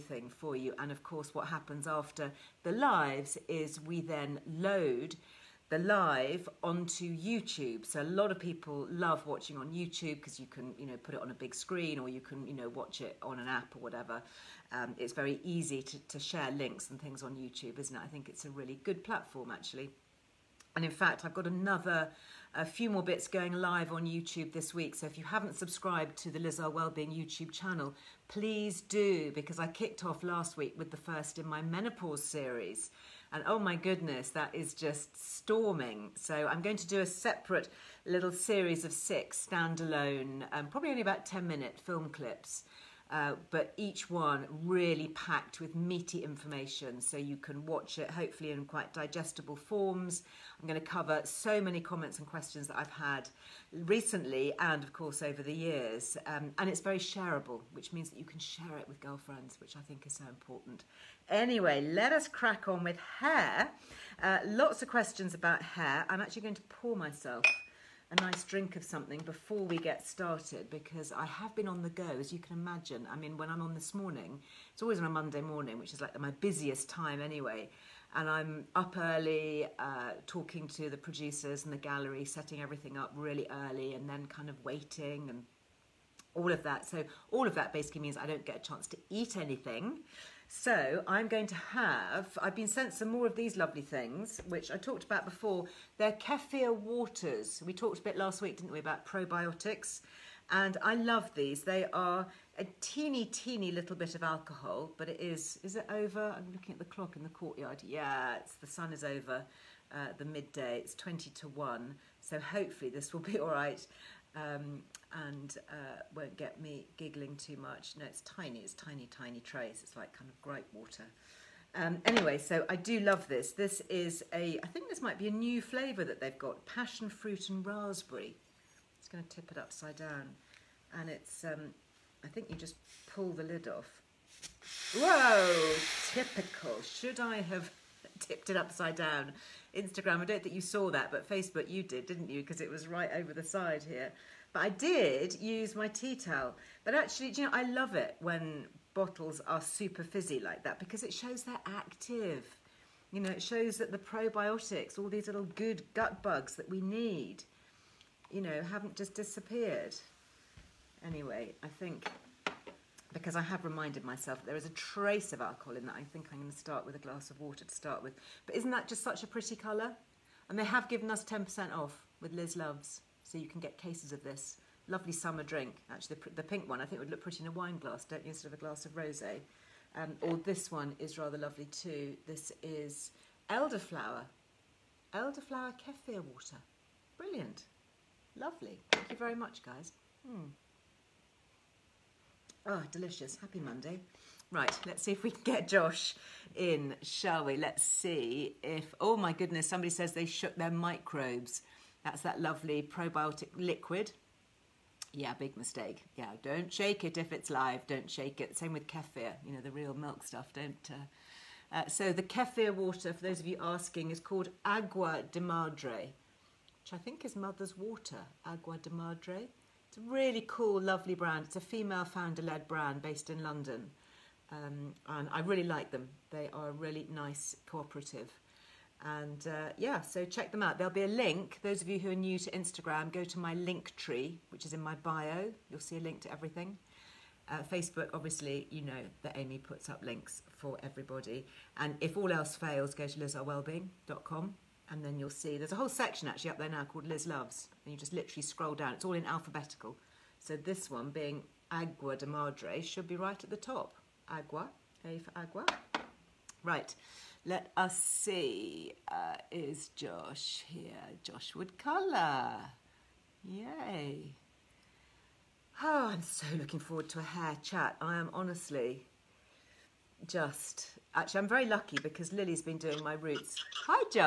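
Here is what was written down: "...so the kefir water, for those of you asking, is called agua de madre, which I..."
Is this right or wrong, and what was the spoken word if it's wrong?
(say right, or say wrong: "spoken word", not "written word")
right.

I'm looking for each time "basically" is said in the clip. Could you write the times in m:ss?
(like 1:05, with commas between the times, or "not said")
1:27.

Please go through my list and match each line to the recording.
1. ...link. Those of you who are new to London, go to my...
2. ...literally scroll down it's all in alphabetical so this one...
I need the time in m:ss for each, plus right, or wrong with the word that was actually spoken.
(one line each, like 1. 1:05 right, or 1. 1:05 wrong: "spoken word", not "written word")
1. 3:51 wrong: "Instagram", not "London"
2. 4:08 right.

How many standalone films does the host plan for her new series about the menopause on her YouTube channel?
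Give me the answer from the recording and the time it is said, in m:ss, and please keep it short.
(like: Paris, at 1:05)
6, at 0:38.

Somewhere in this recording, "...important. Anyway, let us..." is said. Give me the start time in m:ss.
1:00.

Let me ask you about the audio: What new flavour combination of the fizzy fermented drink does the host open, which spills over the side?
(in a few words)
passion fruit and raspberry.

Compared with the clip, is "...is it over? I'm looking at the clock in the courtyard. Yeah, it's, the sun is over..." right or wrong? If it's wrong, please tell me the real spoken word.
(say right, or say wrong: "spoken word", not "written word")
right.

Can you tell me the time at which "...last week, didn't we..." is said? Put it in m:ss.
1:38.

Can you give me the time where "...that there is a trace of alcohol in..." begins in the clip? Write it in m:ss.
2:44.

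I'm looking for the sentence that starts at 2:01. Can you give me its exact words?
Um, anyway, so I do love this.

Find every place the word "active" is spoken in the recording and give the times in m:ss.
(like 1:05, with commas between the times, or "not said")
2:31.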